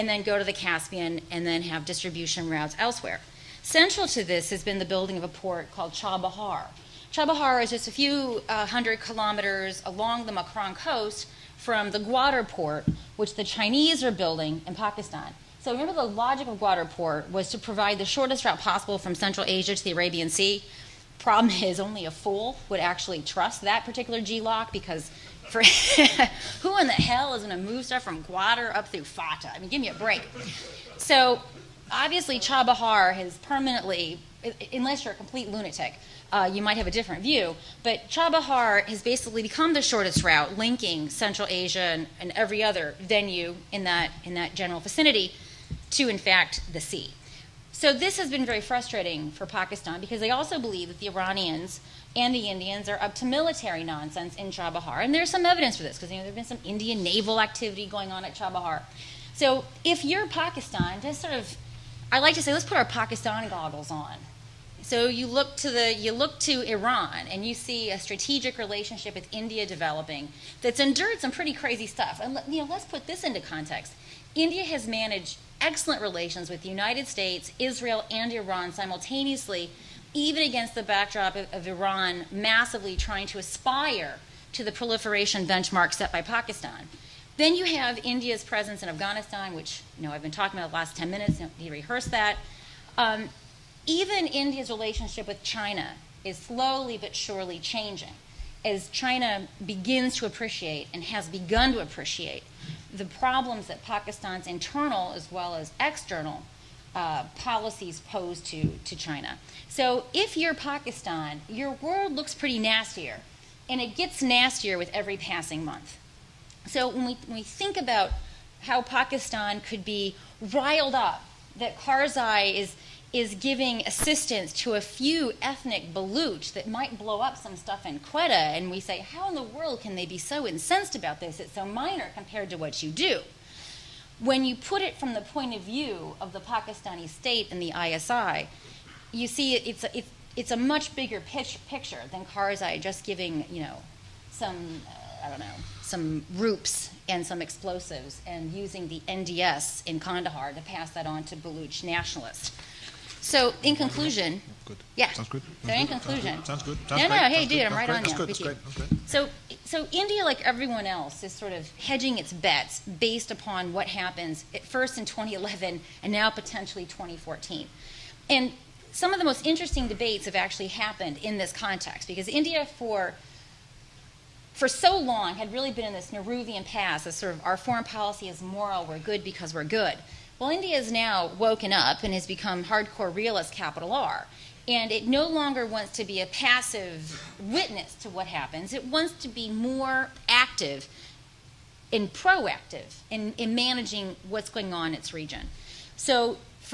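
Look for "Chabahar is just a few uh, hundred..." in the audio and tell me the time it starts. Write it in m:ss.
0:07.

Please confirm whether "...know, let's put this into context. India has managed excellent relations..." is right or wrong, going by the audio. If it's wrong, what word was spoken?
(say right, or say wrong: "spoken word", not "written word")
right.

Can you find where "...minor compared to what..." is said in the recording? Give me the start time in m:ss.
2:11.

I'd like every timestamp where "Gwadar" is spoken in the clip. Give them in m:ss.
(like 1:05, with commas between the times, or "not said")
0:11, 0:16, 0:28.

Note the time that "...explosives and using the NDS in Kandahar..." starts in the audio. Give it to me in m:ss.
2:27.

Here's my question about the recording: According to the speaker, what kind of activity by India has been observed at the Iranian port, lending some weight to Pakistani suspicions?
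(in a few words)
Indian naval activity.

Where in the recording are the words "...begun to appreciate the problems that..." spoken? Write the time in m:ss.
1:41.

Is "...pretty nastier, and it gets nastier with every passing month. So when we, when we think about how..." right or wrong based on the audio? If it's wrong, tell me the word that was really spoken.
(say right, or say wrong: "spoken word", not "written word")
right.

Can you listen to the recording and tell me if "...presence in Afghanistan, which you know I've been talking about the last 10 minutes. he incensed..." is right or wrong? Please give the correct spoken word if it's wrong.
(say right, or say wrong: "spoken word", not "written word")
wrong: "rehearsed", not "incensed".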